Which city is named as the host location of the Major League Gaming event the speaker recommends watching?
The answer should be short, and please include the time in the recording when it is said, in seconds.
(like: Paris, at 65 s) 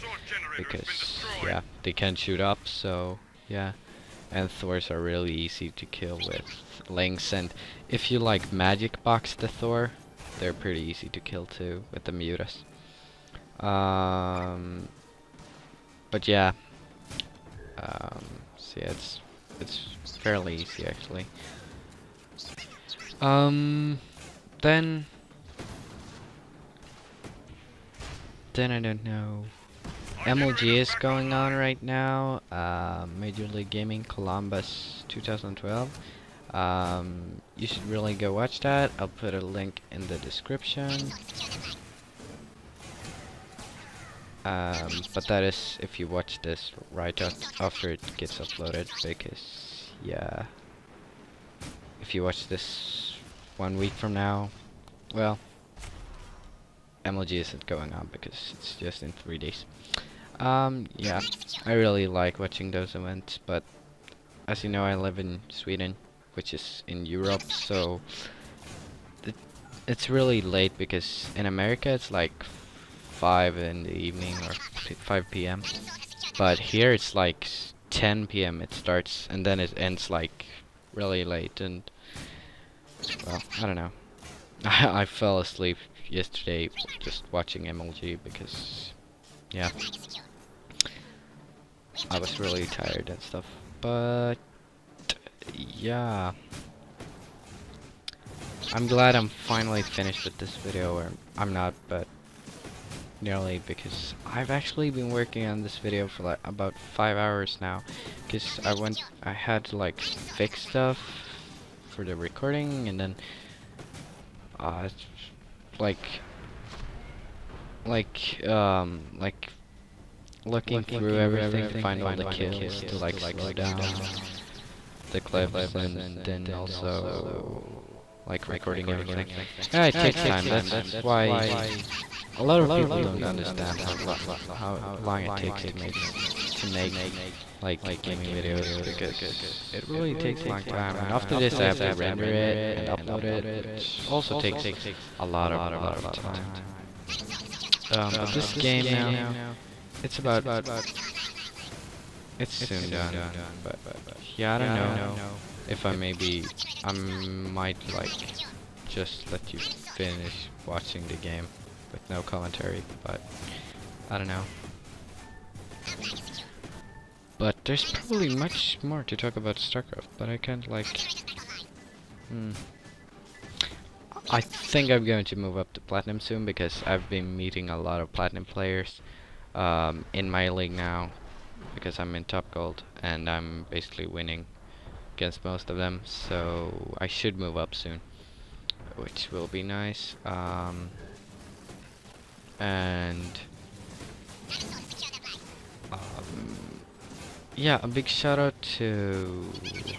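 Columbus, at 34 s.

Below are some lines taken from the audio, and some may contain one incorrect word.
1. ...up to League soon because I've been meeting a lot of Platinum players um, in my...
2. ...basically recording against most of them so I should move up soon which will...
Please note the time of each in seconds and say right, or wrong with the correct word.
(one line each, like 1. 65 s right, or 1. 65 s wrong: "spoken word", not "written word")
1. 175 s wrong: "Platinum", not "League"
2. 183 s wrong: "winning", not "recording".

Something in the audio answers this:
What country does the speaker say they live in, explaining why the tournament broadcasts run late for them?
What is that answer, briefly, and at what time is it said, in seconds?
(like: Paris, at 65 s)
Sweden, at 65 s.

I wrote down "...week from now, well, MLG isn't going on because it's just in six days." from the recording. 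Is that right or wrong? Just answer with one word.
wrong.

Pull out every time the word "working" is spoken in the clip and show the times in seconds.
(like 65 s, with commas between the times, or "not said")
105 s.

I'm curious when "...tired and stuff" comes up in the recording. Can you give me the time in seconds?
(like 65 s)
92 s.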